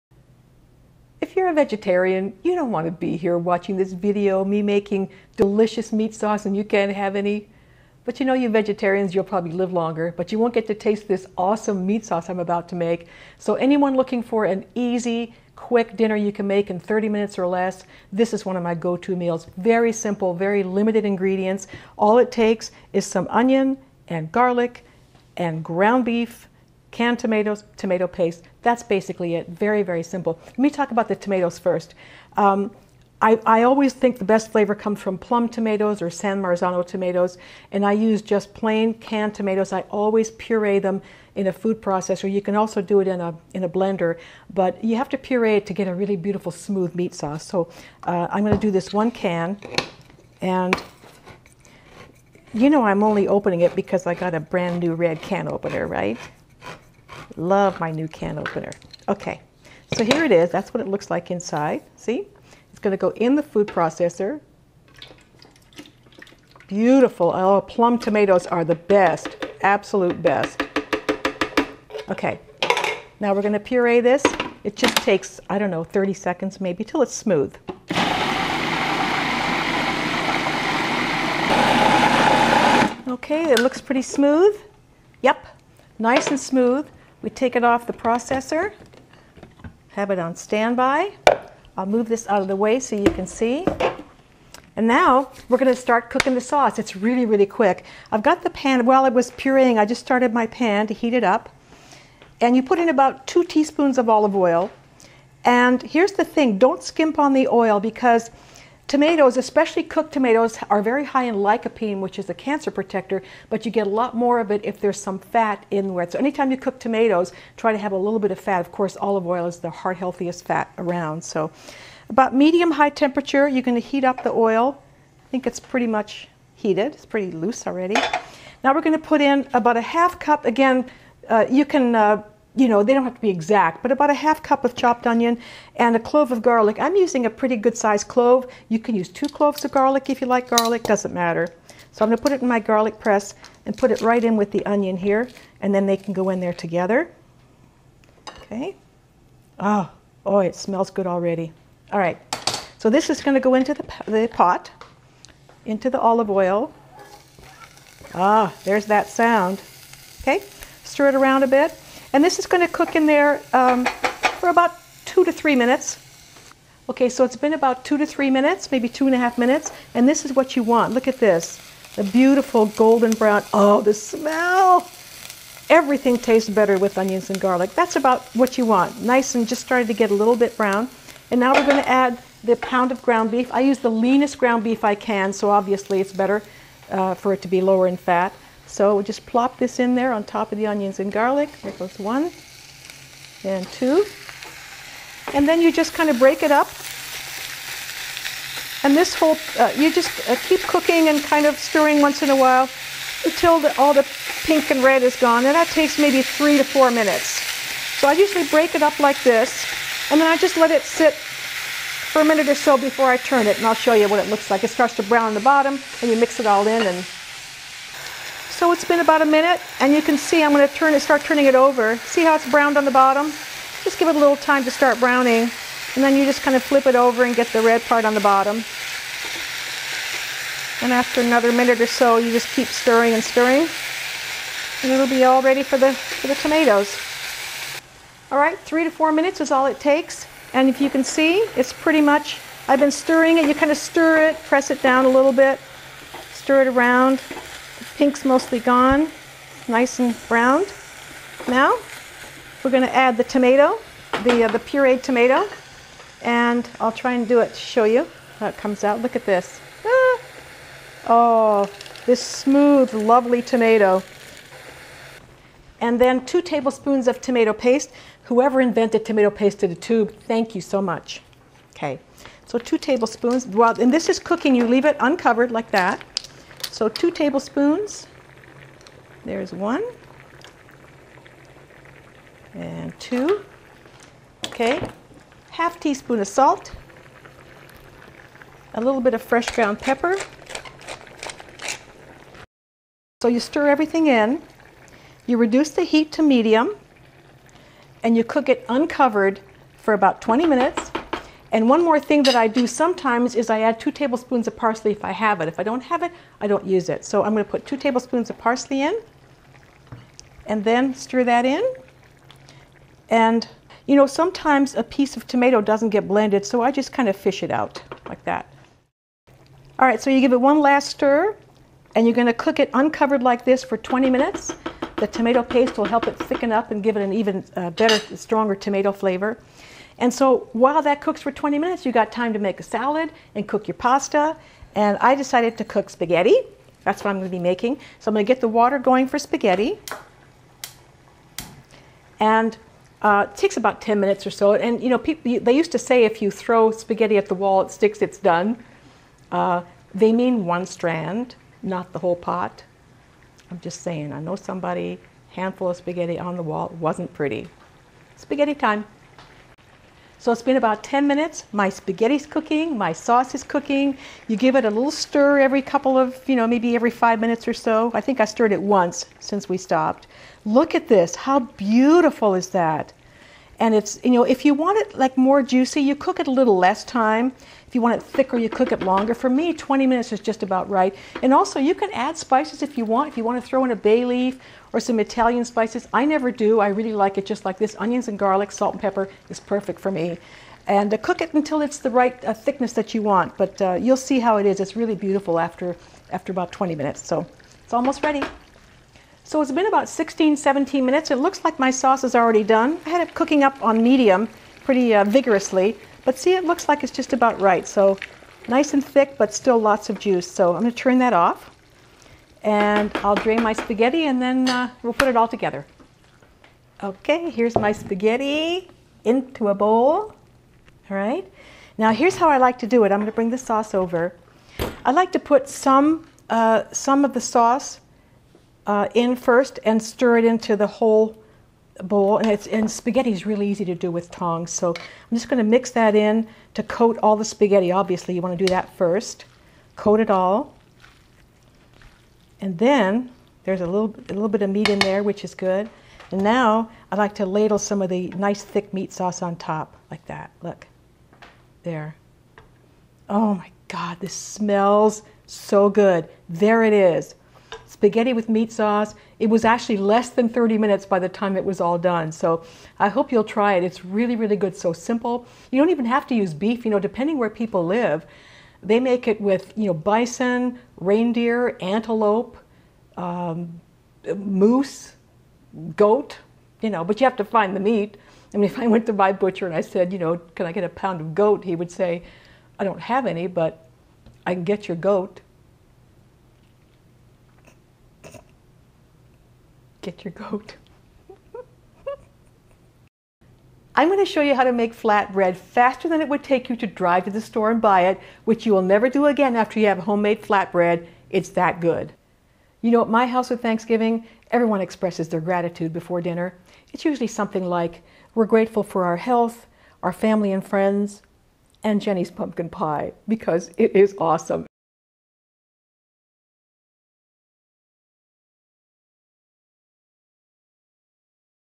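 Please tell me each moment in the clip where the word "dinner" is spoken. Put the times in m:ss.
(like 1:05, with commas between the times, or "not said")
0:15, 8:25.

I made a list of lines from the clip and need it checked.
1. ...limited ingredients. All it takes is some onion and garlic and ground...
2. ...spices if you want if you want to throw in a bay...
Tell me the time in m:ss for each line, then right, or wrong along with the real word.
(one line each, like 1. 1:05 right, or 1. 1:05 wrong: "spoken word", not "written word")
1. 0:20 right
2. 6:22 right.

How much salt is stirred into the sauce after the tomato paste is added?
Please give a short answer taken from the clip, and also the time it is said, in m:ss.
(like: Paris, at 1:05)
half teaspoon, at 4:45.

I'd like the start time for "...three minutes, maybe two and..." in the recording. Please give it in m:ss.
2:48.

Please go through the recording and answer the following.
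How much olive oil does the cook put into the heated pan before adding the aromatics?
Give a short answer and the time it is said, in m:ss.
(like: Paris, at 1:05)
2 teaspoons, at 1:43.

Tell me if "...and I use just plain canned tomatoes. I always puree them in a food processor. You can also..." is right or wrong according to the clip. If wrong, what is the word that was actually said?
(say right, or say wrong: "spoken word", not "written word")
right.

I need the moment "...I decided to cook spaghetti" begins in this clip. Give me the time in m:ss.
5:34.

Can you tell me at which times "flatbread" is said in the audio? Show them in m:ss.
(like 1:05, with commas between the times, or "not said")
8:14, 8:20.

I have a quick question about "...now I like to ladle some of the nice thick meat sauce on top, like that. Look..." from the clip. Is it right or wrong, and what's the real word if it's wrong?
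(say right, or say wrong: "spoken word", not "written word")
right.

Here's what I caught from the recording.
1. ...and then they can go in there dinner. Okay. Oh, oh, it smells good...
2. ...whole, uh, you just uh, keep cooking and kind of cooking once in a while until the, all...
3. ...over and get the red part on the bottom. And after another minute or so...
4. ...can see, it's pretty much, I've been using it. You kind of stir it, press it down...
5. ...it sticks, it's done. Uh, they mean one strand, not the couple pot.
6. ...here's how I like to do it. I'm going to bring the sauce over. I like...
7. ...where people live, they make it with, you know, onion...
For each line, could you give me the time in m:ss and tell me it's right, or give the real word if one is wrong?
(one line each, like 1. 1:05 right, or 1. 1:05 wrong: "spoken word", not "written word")
1. 2:25 wrong: "together", not "dinner"
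2. 3:19 wrong: "stirring", not "cooking"
3. 3:46 right
4. 4:00 wrong: "stirring", not "using"
5. 5:47 wrong: "whole", not "couple"
6. 7:01 right
7. 7:47 wrong: "bison", not "onion".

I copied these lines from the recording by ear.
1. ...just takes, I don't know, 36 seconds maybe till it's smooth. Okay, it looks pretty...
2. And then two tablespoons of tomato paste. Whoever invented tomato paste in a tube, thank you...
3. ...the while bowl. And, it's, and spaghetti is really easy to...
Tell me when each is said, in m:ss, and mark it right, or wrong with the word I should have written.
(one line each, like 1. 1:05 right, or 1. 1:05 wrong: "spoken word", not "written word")
1. 1:14 wrong: "30", not "36"
2. 4:25 right
3. 7:10 wrong: "whole", not "while".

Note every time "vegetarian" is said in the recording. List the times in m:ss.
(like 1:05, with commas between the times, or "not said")
0:01, 0:08.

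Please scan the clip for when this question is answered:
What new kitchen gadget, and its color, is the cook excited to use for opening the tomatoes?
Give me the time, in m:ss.
0:54.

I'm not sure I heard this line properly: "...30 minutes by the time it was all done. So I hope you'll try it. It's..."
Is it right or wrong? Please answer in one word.
right.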